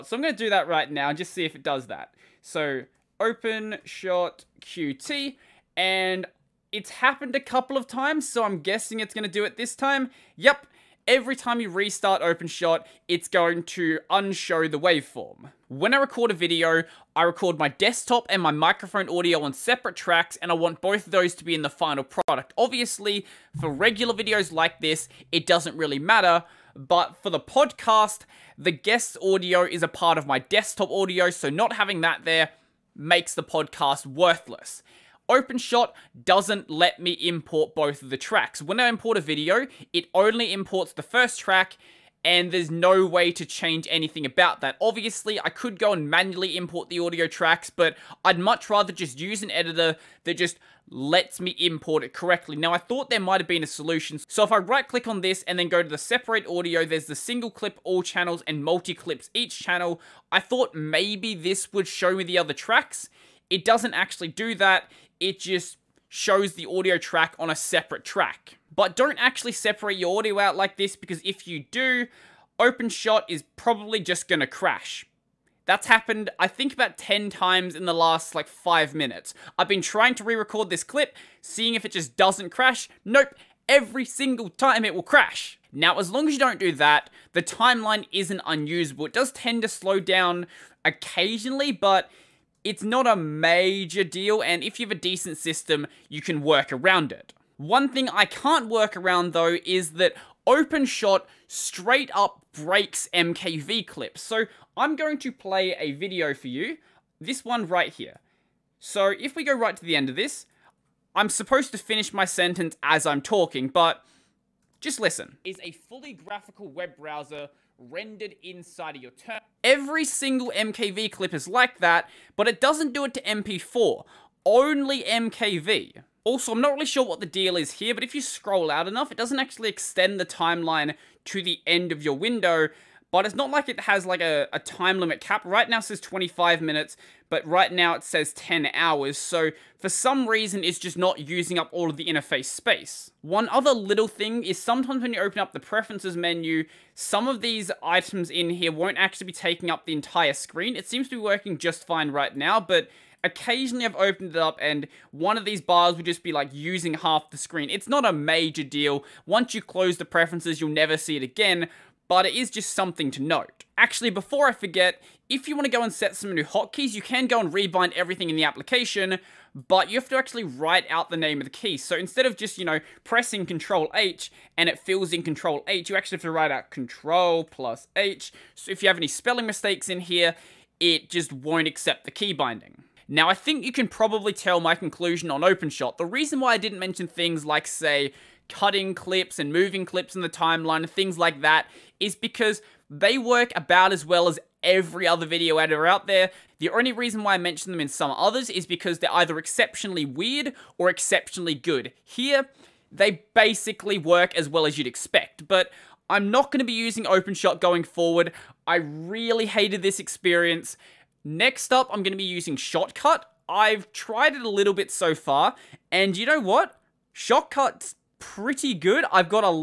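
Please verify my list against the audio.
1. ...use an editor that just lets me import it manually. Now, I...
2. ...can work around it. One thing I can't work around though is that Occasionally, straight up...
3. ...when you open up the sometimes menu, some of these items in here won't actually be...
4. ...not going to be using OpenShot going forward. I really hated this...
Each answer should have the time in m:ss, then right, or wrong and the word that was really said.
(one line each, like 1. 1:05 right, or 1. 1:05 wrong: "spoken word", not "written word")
1. 0:49 wrong: "correctly", not "manually"
2. 1:36 wrong: "OpenShot", not "Occasionally"
3. 2:25 wrong: "preferences", not "sometimes"
4. 3:26 right.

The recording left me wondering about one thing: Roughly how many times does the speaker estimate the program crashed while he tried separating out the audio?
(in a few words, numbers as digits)
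10.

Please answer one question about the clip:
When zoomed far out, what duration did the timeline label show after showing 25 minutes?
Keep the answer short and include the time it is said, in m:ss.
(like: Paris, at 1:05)
10 hours, at 2:18.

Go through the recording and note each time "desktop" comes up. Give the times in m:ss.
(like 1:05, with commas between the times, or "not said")
0:17, 0:30.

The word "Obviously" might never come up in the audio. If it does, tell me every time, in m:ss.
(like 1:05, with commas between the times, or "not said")
0:22, 0:44.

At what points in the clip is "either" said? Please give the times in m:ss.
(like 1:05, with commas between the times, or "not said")
3:19.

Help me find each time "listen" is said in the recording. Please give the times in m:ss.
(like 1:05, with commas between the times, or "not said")
1:54.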